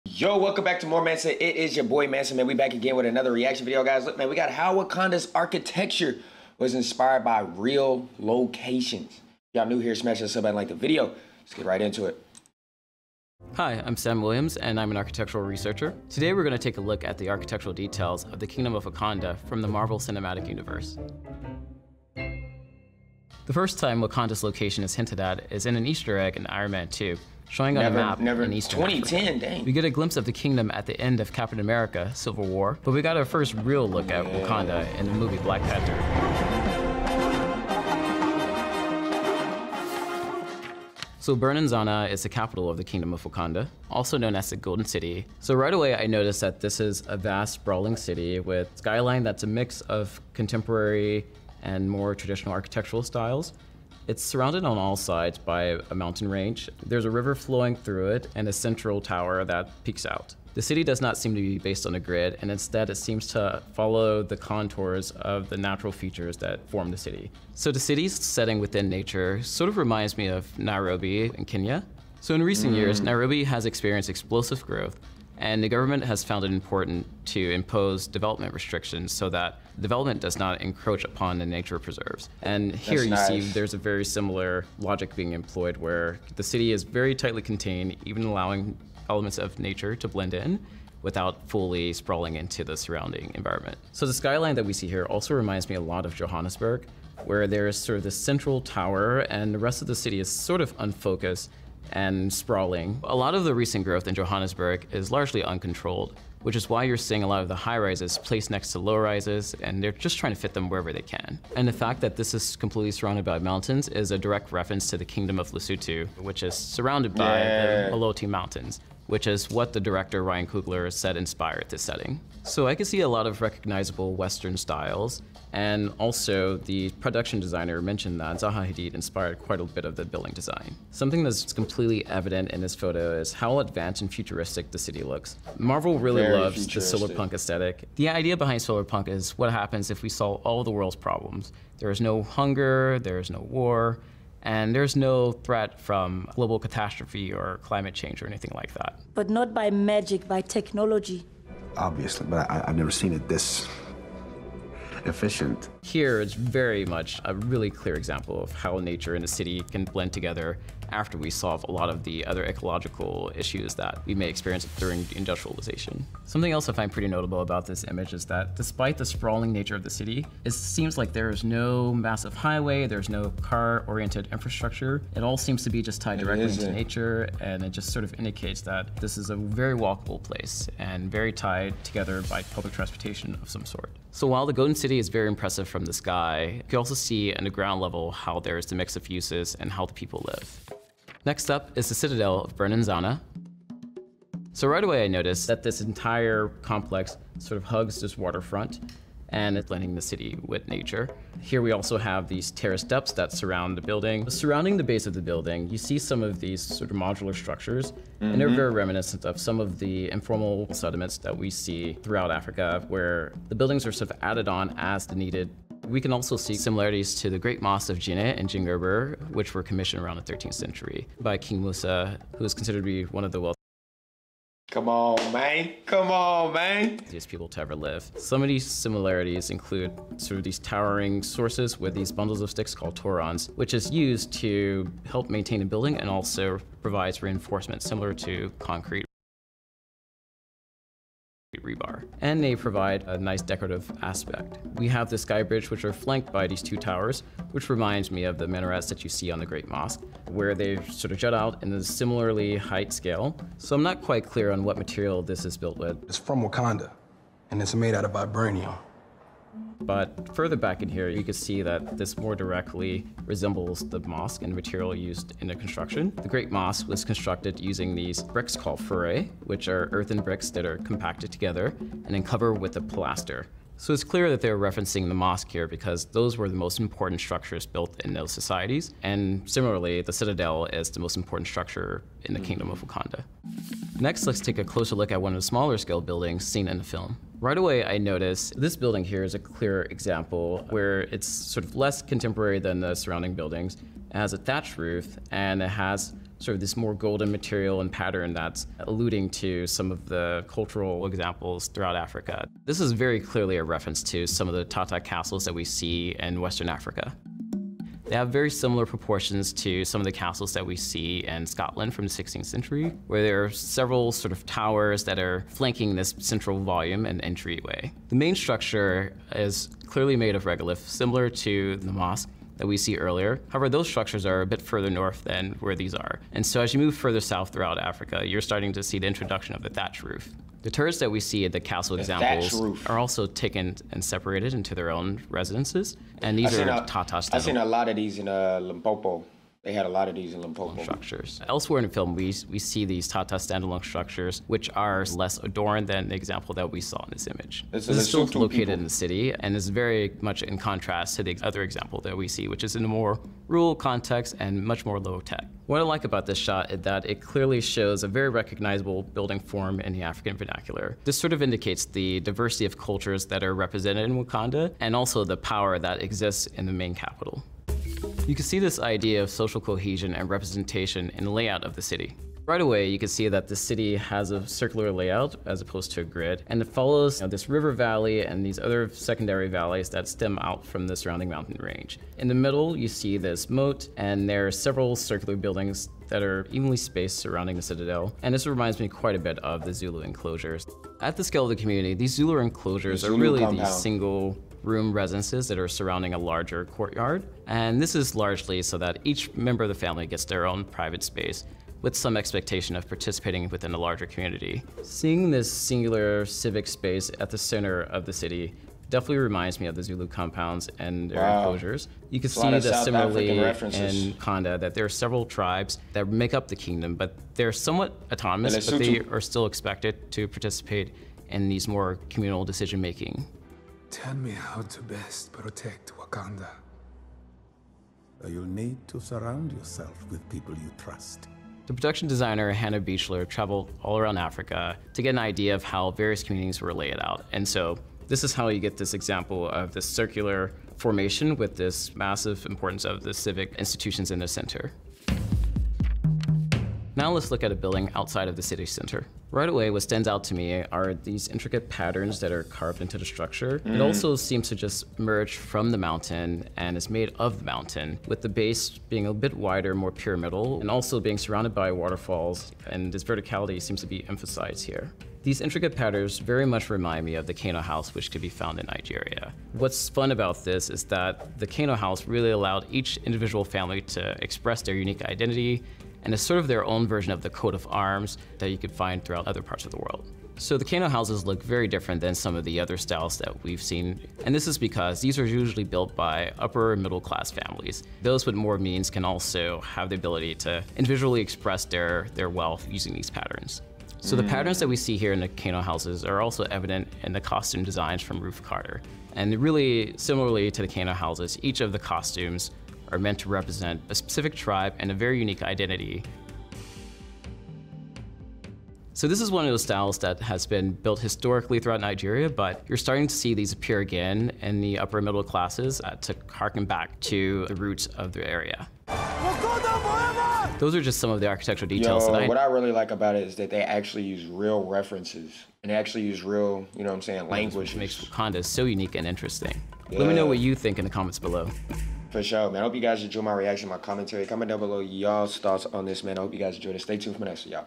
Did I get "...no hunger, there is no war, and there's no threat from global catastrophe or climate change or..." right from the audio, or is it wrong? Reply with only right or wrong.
right.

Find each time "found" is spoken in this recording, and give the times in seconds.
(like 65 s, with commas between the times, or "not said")
76 s, 468 s.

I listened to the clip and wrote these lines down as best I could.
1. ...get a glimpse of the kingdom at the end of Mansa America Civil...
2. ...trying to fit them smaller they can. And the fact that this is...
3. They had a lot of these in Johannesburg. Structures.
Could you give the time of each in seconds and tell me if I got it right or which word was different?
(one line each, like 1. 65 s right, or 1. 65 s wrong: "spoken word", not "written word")
1. 29 s wrong: "Captain", not "Mansa"
2. 110 s wrong: "wherever", not "smaller"
3. 339 s wrong: "Limpopo", not "Johannesburg".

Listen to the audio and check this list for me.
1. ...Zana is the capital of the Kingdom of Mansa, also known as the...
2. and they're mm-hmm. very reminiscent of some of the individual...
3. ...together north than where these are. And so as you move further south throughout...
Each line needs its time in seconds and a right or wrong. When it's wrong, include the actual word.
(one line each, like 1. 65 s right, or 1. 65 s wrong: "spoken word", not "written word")
1. 41 s wrong: "Wakanda", not "Mansa"
2. 208 s wrong: "informal", not "individual"
3. 324 s wrong: "further", not "together".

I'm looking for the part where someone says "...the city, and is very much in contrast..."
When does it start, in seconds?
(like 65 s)
348 s.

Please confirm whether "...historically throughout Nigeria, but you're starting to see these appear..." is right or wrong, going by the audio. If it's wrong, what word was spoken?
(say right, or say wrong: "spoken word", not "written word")
right.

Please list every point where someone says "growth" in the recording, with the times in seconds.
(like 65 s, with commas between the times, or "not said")
74 s, 103 s.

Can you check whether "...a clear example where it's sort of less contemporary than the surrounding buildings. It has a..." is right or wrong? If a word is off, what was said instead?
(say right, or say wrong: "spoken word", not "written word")
right.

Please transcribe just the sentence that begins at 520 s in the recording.
Those are just some of the architectural details.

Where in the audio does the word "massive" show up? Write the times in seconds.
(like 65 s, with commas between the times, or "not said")
171 s, 441 s.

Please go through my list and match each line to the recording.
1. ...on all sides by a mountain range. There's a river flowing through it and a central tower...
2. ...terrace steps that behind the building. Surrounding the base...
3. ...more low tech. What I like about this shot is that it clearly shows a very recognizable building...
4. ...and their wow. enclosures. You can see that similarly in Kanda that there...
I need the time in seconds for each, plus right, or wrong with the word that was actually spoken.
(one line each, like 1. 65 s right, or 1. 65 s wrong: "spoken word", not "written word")
1. 54 s right
2. 202 s wrong: "surround", not "behind"
3. 354 s right
4. 410 s right.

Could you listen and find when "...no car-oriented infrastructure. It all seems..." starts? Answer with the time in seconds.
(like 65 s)
173 s.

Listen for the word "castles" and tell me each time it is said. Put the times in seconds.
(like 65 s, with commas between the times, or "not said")
304 s, 310 s, 331 s.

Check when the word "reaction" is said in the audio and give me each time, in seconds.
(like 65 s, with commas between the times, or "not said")
3 s, 533 s.